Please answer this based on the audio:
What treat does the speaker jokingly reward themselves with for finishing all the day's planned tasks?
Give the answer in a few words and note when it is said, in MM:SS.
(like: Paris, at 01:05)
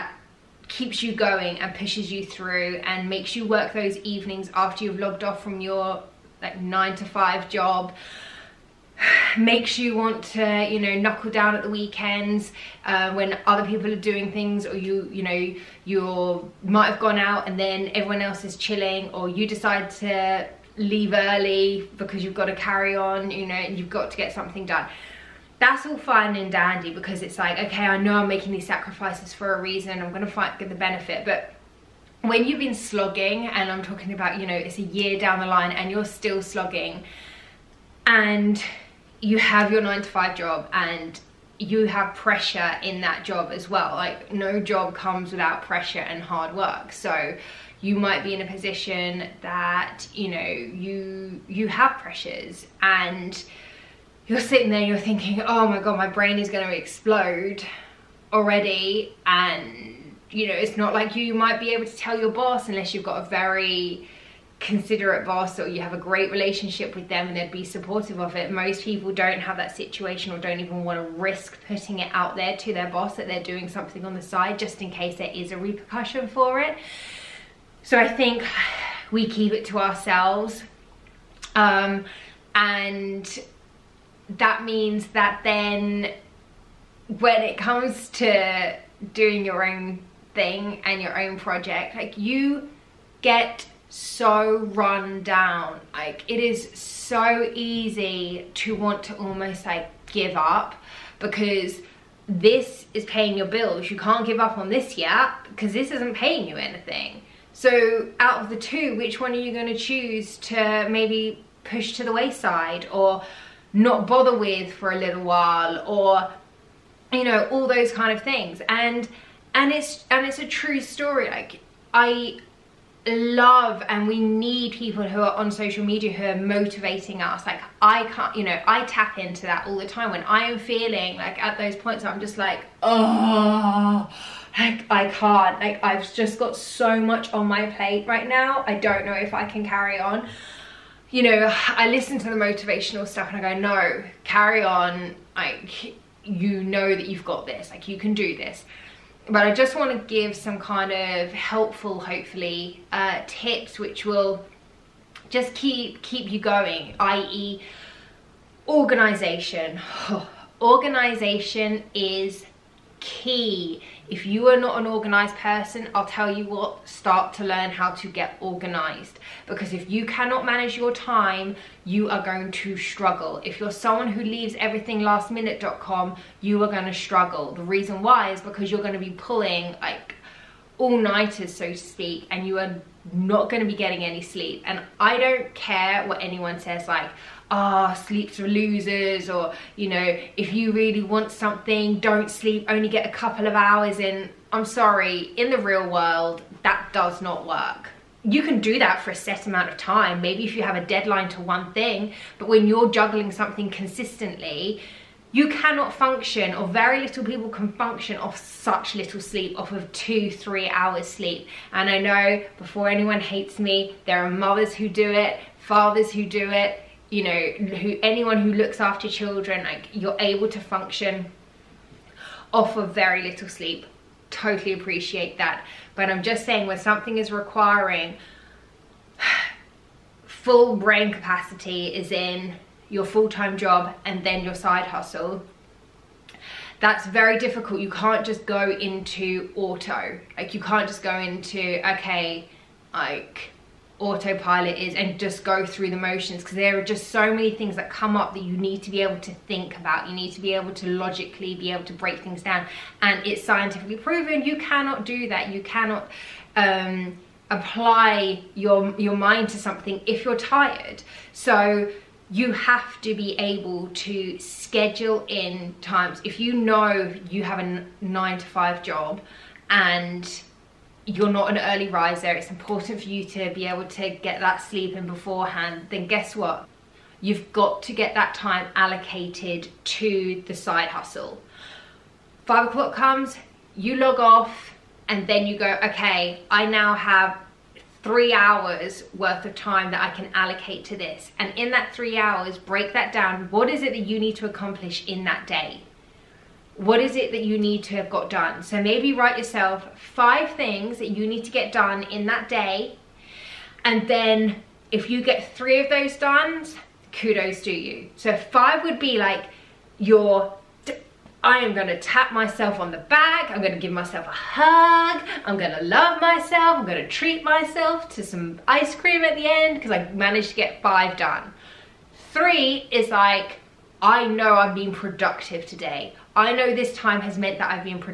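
Ice cream, at 05:18.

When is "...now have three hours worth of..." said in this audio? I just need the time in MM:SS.
04:46.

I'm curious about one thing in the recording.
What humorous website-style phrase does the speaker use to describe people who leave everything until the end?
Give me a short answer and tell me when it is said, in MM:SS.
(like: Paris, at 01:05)
lastminute.com, at 02:55.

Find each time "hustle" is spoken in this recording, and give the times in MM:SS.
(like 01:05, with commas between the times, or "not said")
03:54, 04:40.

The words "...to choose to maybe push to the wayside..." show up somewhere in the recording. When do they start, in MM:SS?
01:49.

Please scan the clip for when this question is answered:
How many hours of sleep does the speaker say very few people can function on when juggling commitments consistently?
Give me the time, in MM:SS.
03:29.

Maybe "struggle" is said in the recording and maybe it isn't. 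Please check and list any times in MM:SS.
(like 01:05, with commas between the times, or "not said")
02:52, 02:56.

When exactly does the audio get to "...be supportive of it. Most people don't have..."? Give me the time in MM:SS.
01:07.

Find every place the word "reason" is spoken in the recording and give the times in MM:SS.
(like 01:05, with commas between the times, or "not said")
00:29, 02:57.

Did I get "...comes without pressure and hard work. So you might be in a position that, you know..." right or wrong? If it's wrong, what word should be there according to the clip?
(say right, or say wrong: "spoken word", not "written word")
right.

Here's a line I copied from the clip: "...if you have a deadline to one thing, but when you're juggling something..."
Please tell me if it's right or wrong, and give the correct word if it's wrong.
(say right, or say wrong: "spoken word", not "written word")
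right.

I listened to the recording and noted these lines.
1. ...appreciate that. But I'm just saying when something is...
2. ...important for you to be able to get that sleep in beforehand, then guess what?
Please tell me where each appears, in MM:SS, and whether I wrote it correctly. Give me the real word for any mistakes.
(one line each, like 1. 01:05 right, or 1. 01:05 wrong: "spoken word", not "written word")
1. 03:44 right
2. 04:32 right.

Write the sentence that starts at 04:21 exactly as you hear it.
So you have to be able to schedule in times.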